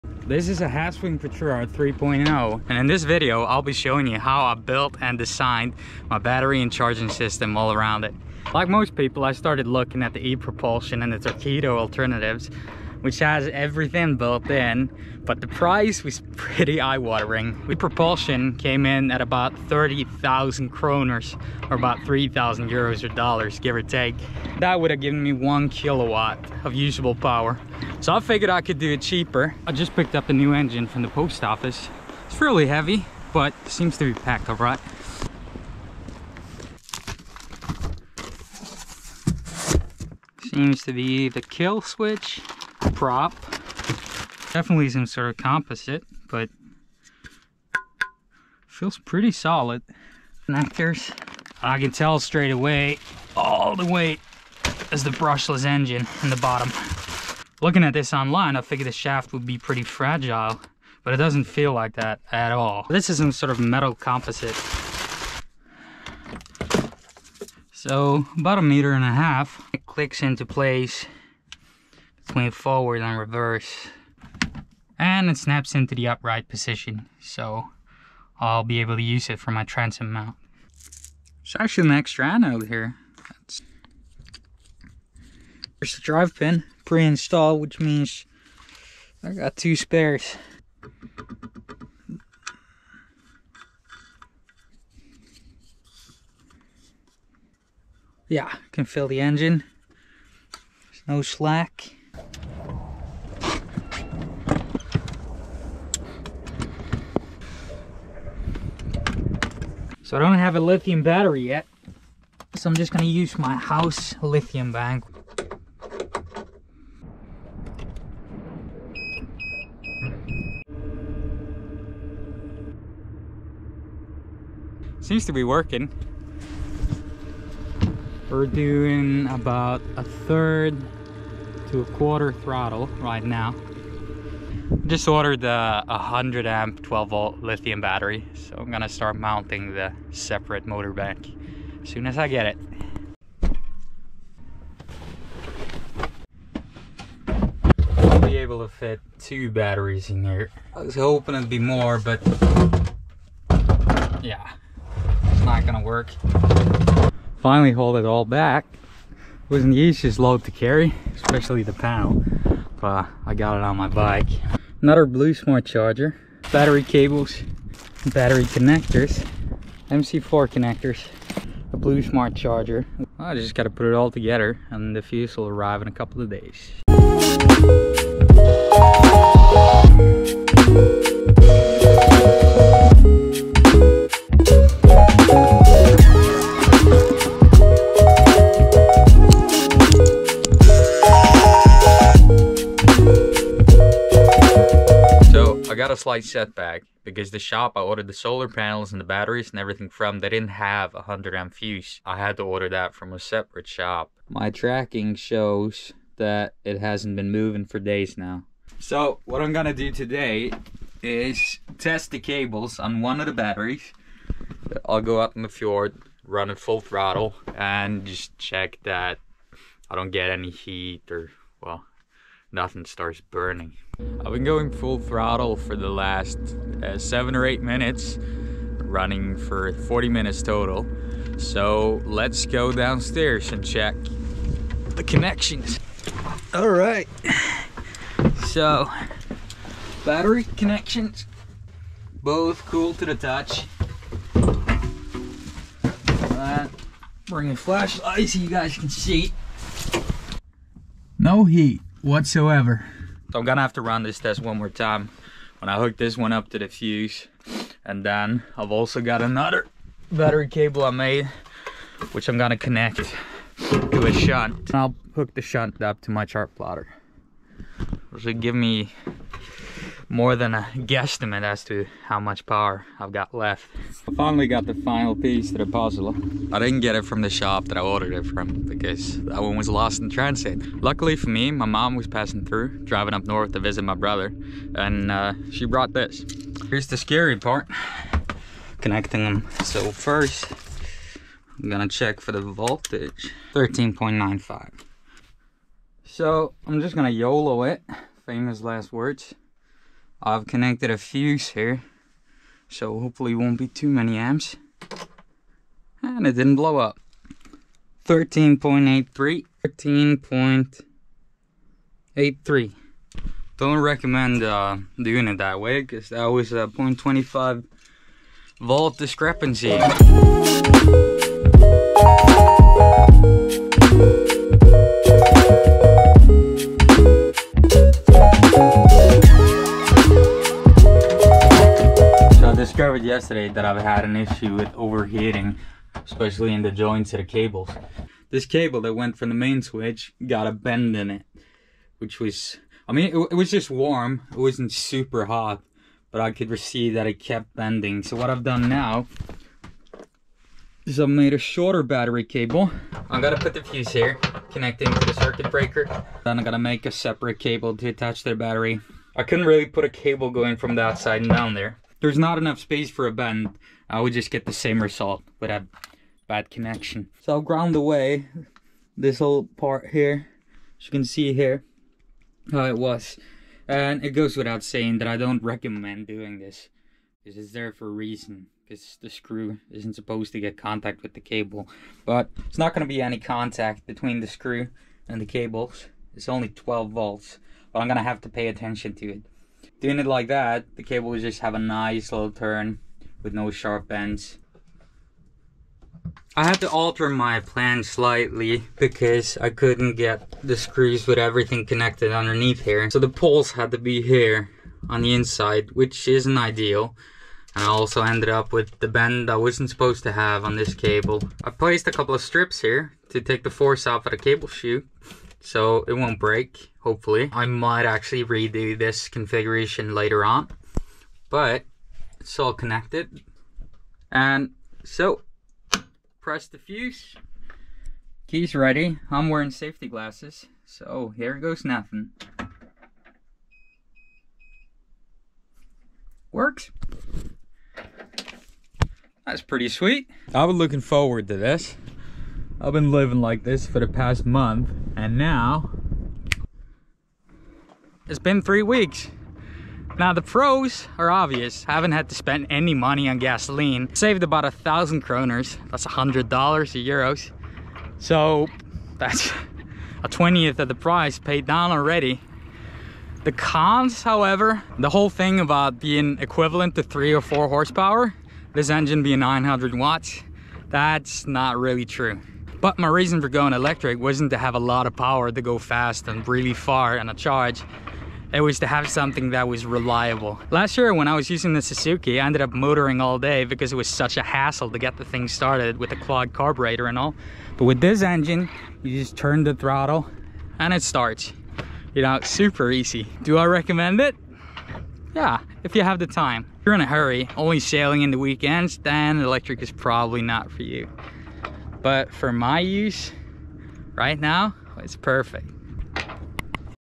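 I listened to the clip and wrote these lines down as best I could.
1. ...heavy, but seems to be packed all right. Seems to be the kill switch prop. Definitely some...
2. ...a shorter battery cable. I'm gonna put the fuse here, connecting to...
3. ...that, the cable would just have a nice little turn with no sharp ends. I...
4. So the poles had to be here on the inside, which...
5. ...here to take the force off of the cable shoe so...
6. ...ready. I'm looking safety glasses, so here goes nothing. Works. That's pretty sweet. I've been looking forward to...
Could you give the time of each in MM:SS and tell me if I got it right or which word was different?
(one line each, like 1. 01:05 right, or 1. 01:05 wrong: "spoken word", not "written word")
1. 00:32 right
2. 05:51 right
3. 06:30 right
4. 06:42 right
5. 06:52 right
6. 07:08 wrong: "wearing", not "looking".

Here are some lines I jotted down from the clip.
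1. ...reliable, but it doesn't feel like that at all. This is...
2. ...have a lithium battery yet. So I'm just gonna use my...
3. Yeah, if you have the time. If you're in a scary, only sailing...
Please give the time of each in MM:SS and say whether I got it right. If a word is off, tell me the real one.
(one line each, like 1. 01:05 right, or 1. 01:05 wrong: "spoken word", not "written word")
1. 00:59 wrong: "fragile", not "reliable"
2. 01:50 right
3. 08:15 wrong: "hurry", not "scary".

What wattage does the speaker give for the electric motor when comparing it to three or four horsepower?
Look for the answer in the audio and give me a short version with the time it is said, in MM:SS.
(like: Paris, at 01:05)
900 watts, at 07:49.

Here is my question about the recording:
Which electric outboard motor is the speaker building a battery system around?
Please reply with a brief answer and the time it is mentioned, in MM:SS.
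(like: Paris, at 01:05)
Haswing Protruar 3.0, at 00:00.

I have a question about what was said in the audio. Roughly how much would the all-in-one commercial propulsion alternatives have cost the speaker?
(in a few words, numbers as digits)
30,000 kroners.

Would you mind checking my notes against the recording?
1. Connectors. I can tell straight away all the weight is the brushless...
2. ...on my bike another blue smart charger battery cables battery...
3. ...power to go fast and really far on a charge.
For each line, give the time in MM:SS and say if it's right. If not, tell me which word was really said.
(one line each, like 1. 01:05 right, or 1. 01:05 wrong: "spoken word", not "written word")
1. 00:50 right
2. 02:43 right
3. 07:54 right.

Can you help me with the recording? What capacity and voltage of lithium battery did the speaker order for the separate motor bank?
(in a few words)
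100 amp 12 volt.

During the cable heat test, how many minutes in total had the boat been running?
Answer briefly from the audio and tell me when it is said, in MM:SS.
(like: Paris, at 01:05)
40 minutes, at 03:49.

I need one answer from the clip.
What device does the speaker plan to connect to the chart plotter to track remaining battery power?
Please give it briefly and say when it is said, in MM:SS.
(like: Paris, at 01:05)
a shunt, at 04:24.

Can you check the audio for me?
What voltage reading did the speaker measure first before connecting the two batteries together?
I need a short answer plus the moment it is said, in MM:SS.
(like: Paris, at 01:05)
13.95, at 04:53.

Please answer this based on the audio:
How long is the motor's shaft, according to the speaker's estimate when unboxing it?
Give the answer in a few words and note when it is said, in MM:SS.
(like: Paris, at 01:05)
a meter and a half, at 01:08.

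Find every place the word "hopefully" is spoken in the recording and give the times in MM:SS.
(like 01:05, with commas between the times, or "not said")
05:02, 06:56.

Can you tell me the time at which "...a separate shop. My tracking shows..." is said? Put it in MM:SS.
03:23.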